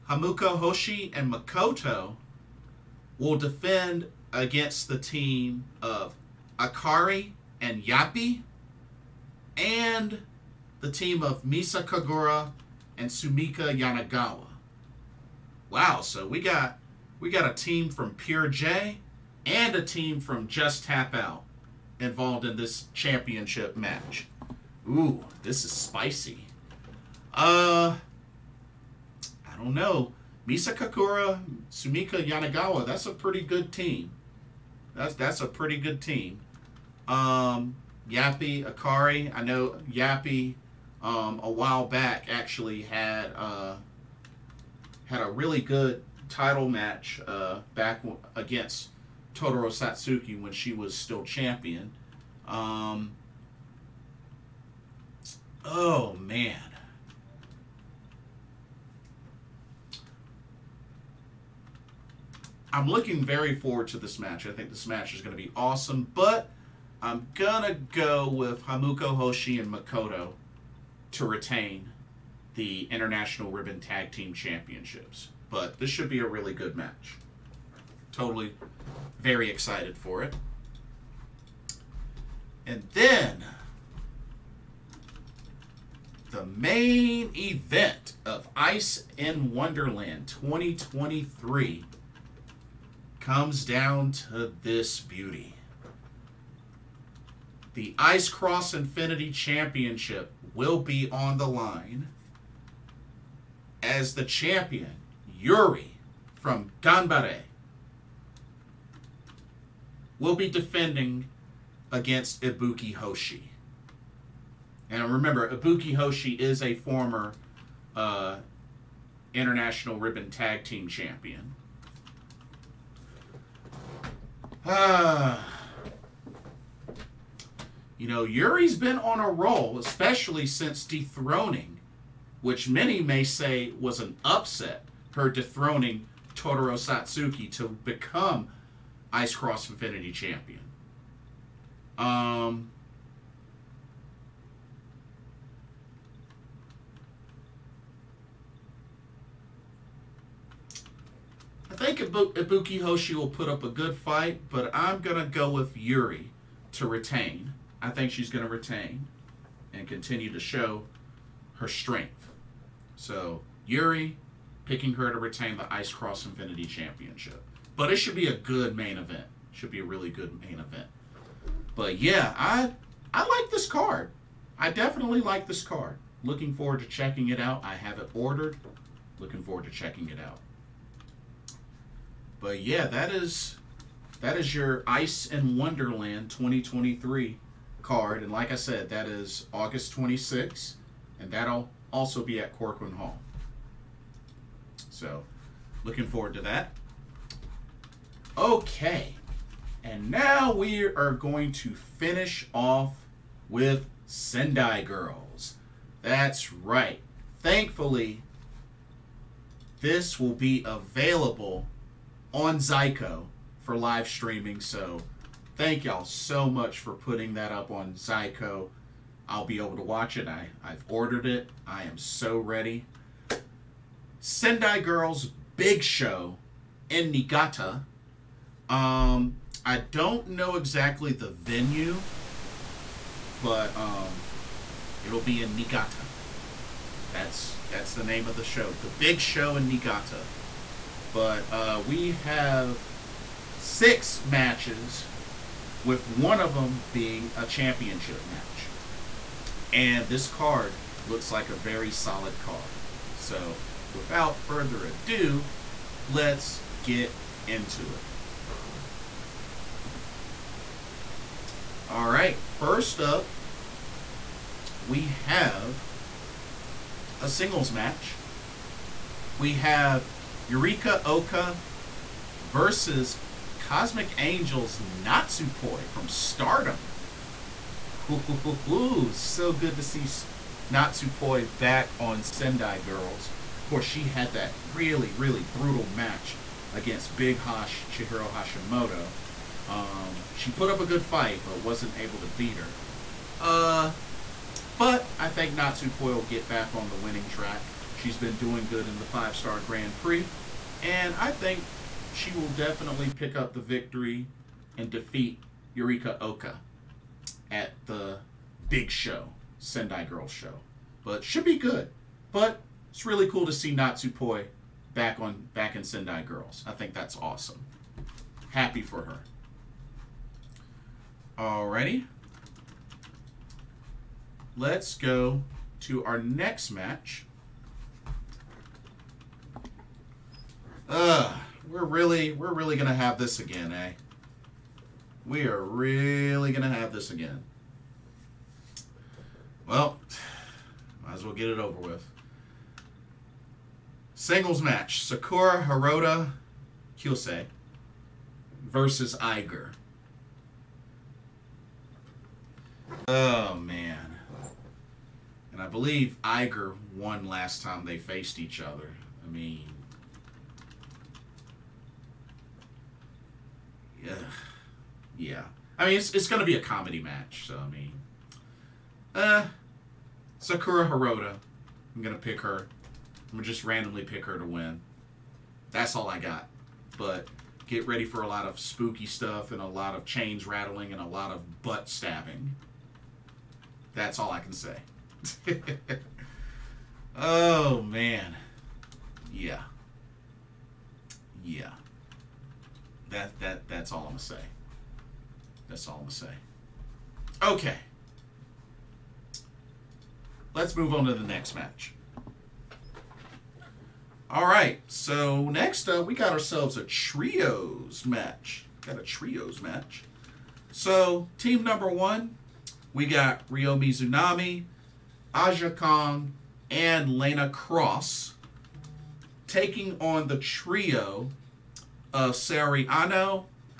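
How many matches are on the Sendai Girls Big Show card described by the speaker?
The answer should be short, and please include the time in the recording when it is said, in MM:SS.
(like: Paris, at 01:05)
6, at 04:03.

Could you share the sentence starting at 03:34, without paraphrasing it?
So thank y'all so much for putting that up on Zyco.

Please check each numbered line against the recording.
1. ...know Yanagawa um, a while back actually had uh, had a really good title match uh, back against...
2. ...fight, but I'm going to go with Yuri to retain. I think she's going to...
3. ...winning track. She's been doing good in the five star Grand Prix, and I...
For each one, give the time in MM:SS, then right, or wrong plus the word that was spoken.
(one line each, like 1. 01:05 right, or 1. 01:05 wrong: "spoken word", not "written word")
1. 00:39 wrong: "Yappy", not "Yanagawa"
2. 02:33 right
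3. 04:56 right.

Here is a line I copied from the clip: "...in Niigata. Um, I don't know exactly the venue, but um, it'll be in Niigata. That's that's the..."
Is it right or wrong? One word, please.
right.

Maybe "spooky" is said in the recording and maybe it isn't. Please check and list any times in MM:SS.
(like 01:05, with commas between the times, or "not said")
06:18.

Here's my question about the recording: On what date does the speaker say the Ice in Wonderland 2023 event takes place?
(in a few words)
August 26th.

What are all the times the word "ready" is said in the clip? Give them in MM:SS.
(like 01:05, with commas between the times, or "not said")
03:42, 06:17.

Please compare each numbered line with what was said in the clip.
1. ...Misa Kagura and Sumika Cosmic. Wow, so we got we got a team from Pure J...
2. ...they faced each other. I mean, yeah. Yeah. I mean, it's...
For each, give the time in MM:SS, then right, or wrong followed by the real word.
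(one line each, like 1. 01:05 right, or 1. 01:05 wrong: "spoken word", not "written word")
1. 00:11 wrong: "Yanagawa", not "Cosmic"
2. 05:57 right.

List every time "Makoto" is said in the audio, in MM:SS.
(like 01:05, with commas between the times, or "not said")
00:01, 01:09.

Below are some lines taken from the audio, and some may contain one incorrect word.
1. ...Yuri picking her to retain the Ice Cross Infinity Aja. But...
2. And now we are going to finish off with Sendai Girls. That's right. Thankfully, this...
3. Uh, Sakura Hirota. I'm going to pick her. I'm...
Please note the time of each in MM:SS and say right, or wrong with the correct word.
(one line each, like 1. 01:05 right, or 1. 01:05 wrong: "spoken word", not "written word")
1. 02:43 wrong: "Championship", not "Aja"
2. 03:19 right
3. 06:09 right.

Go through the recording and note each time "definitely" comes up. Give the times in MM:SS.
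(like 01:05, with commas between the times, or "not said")
02:54, 05:02.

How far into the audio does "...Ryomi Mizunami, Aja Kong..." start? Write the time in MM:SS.
06:53.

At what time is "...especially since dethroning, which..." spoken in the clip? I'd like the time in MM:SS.
02:09.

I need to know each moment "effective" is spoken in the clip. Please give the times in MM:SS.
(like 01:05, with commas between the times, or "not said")
not said.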